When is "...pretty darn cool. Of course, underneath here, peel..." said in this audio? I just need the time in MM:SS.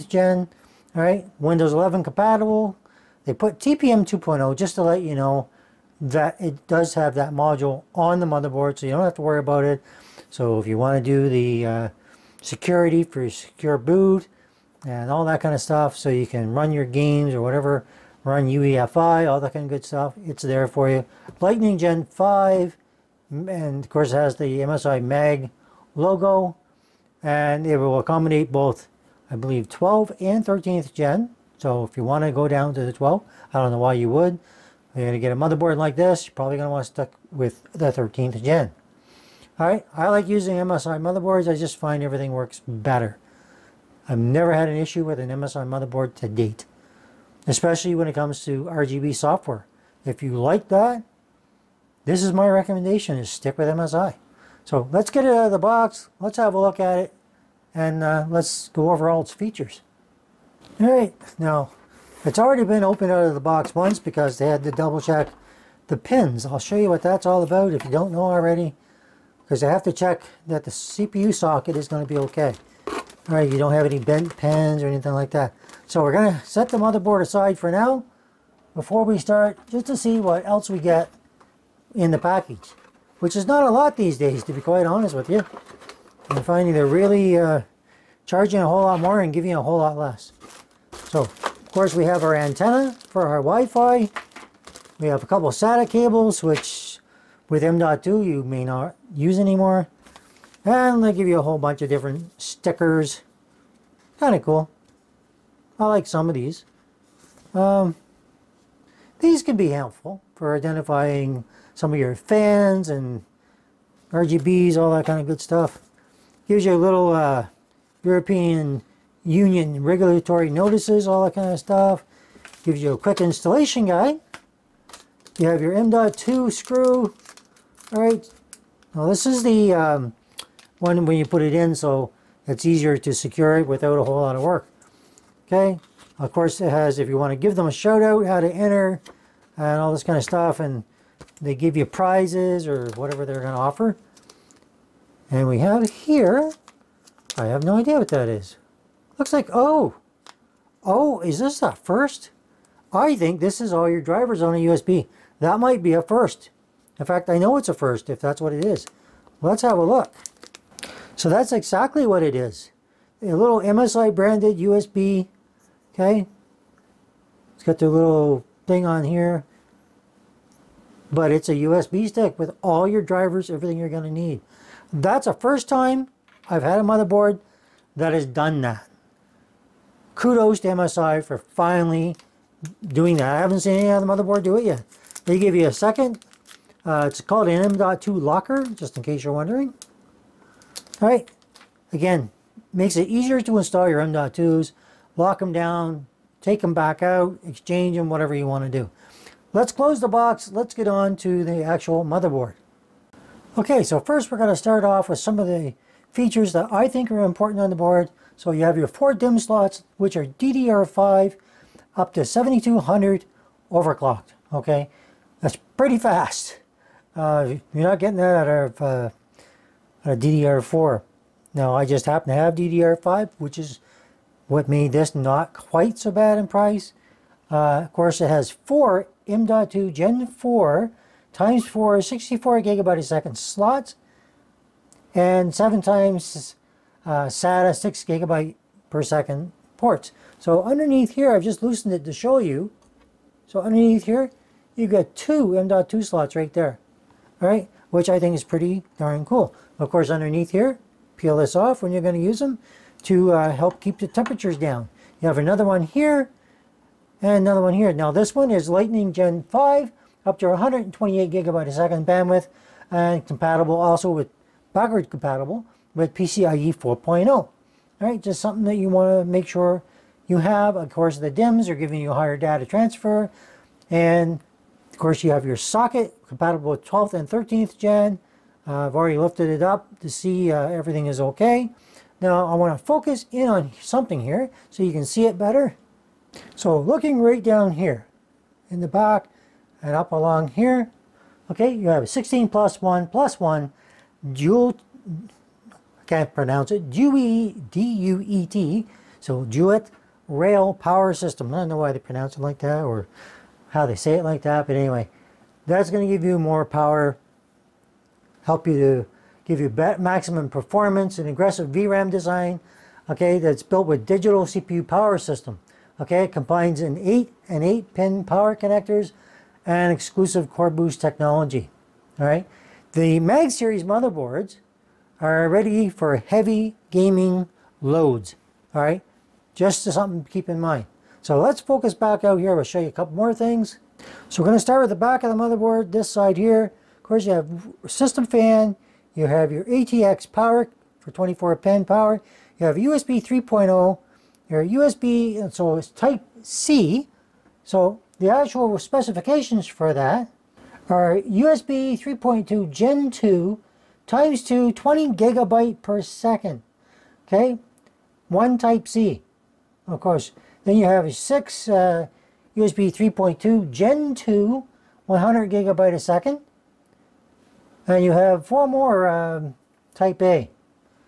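04:08.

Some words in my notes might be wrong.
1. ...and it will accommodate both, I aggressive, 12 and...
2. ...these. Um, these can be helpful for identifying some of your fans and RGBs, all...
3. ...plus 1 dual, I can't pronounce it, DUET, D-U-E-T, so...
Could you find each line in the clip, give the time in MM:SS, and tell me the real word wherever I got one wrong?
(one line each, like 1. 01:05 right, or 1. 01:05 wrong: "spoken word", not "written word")
1. 00:27 wrong: "believe", not "aggressive"
2. 01:46 right
3. 04:53 right.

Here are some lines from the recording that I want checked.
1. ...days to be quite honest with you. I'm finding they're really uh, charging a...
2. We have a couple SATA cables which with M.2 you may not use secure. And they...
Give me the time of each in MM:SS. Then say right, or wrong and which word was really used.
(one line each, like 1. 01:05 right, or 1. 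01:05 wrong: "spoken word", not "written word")
1. 01:24 right
2. 01:34 wrong: "anymore", not "secure".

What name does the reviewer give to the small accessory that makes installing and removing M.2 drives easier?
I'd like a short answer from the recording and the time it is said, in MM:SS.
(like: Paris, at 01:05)
M.2 locker, at 03:07.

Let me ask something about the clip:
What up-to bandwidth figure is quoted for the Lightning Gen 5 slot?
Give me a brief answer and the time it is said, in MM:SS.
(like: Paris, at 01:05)
128 gigabytes per second, at 04:20.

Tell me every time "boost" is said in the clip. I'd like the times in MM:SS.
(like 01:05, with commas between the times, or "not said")
05:20.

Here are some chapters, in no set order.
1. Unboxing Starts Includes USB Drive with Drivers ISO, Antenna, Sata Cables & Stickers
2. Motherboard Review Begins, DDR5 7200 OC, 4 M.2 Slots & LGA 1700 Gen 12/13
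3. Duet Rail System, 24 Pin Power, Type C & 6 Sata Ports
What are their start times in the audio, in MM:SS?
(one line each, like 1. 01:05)
1. 01:00
2. 03:22
3. 04:46.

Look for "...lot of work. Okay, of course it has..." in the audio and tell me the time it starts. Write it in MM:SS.
02:14.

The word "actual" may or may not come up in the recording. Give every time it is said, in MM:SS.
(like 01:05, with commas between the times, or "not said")
03:21, 05:48.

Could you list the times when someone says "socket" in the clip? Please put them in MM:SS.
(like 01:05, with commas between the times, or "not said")
01:11, 04:35.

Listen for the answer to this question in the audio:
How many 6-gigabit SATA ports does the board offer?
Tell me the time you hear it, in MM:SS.
03:55.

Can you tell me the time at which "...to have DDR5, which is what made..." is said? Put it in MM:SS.
03:42.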